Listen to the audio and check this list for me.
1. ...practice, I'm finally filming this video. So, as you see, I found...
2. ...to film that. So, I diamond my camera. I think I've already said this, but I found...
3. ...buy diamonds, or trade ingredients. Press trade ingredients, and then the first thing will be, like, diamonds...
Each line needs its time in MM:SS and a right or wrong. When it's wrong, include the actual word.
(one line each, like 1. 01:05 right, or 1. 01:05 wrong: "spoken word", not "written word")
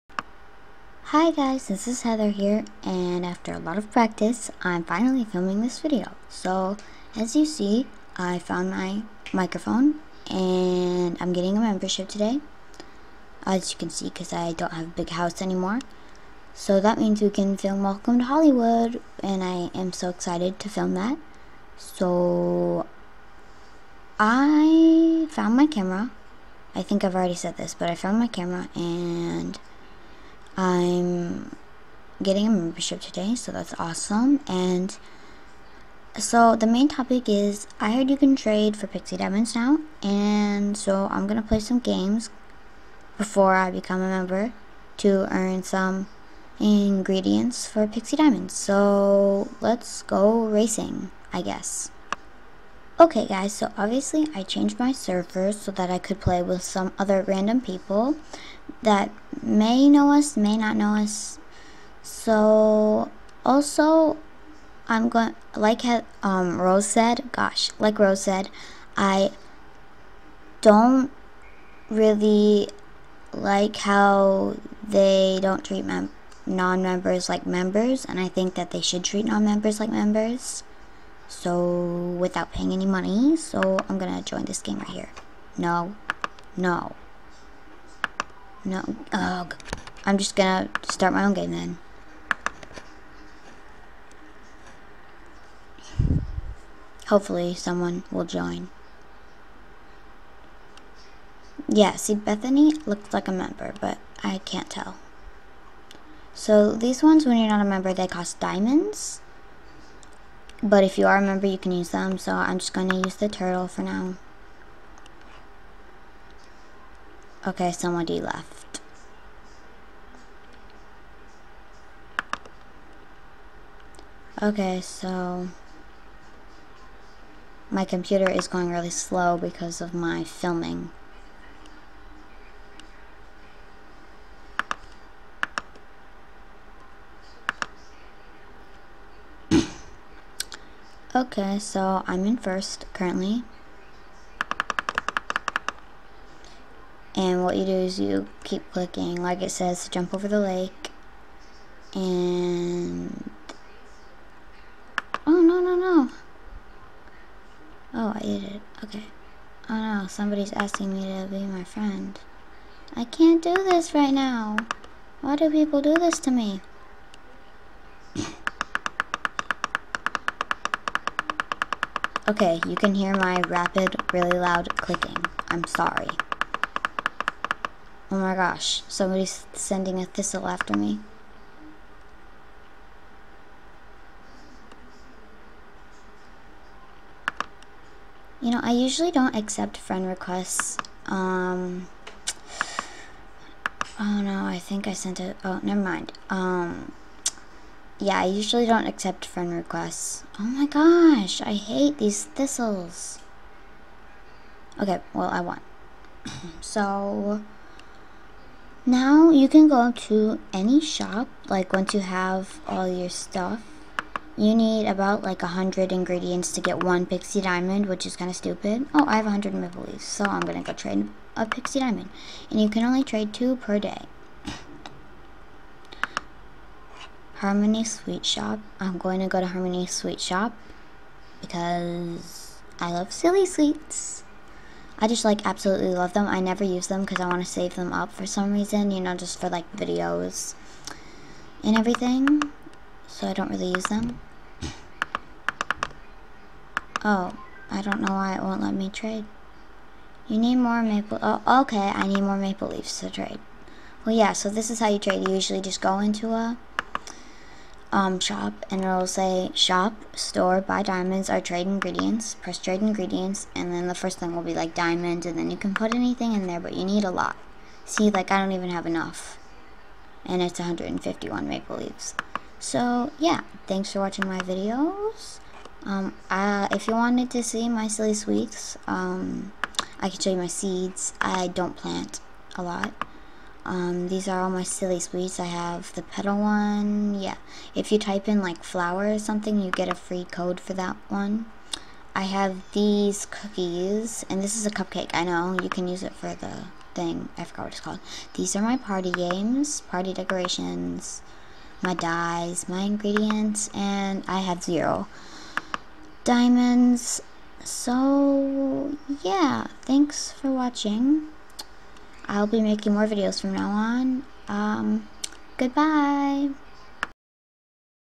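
1. 00:03 right
2. 00:20 wrong: "found", not "diamond"
3. 04:20 right.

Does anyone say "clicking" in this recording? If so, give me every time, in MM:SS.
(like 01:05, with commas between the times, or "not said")
02:28, 02:54.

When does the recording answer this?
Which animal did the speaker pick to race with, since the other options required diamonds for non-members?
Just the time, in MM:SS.
01:53.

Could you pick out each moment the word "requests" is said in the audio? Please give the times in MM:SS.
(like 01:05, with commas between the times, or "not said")
03:10, 03:19.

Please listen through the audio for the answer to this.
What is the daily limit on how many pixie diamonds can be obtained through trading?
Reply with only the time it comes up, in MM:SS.
03:43.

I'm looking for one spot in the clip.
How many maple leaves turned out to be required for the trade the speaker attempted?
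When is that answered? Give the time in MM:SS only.
04:30.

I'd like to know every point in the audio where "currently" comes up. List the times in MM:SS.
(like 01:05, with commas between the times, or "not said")
02:22.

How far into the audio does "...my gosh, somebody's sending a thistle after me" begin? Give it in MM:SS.
02:58.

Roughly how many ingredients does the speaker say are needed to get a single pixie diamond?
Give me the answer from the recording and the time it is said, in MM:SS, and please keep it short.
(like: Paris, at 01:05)
100, at 03:34.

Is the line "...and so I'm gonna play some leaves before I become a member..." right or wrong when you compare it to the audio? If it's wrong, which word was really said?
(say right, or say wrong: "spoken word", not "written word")
wrong: "games", not "leaves".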